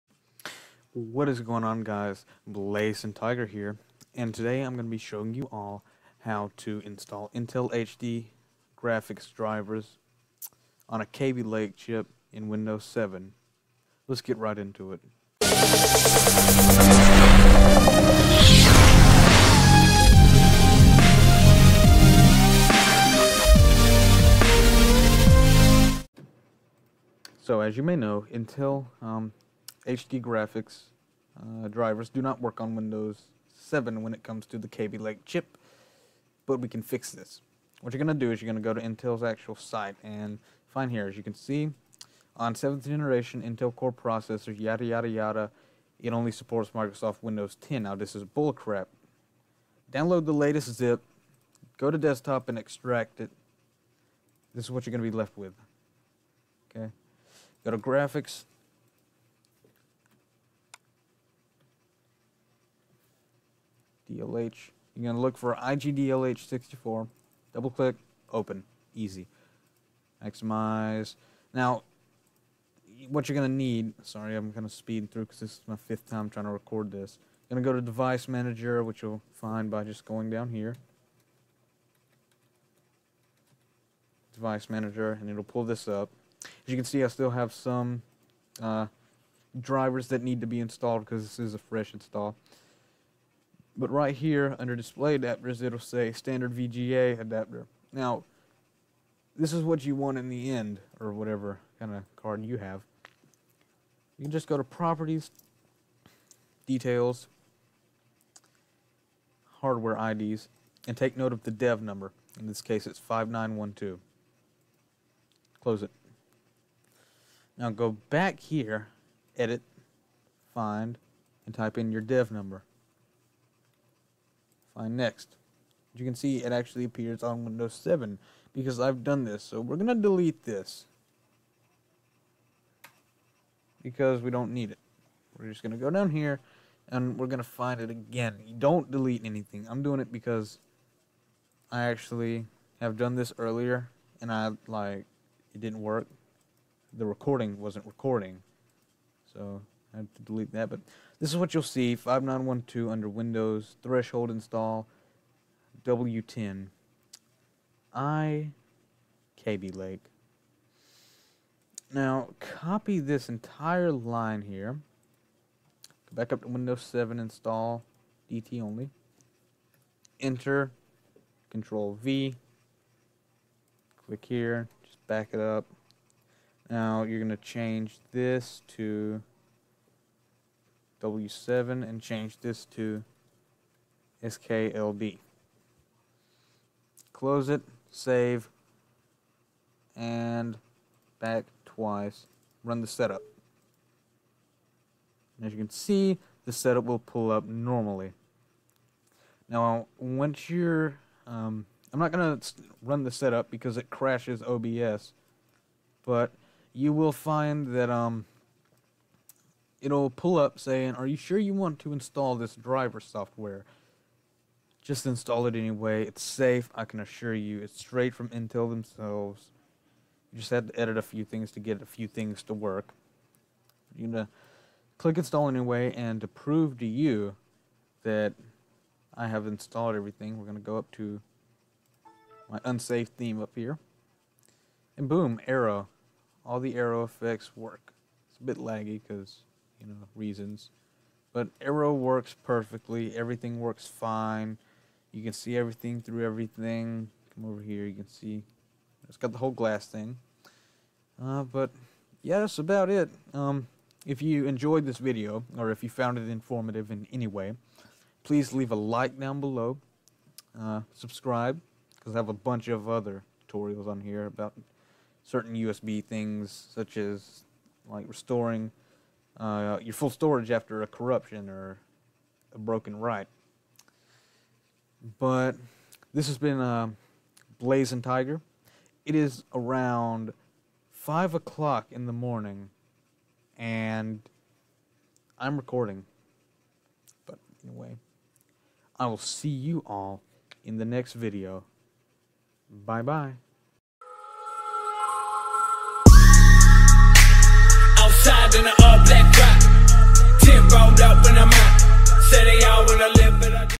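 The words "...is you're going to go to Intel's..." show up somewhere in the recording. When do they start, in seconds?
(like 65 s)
38 s.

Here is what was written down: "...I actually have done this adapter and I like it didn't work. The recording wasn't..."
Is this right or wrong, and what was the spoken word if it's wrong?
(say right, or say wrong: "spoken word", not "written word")
wrong: "earlier", not "adapter".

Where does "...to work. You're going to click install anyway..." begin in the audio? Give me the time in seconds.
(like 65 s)
222 s.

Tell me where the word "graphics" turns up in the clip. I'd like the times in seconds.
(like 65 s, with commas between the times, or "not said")
8 s, 30 s, 57 s.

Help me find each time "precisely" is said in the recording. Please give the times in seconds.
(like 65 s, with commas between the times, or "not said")
not said.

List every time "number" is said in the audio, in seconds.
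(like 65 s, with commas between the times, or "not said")
111 s, 122 s.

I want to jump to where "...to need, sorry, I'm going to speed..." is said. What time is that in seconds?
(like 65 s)
73 s.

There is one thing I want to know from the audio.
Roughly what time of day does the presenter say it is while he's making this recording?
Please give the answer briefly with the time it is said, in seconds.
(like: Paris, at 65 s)
5 o'clock in the morning, at 280 s.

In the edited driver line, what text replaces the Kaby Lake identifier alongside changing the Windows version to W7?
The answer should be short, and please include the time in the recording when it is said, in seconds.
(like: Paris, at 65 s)
SKLB, at 184 s.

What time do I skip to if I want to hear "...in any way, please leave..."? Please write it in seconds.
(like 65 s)
256 s.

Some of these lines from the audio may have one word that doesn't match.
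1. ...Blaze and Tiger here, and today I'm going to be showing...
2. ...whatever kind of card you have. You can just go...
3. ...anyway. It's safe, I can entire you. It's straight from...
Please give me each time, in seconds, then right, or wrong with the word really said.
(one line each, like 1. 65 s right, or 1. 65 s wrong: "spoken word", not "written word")
1. 2 s right
2. 101 s right
3. 215 s wrong: "assure", not "entire".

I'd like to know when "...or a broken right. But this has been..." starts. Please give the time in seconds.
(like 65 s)
271 s.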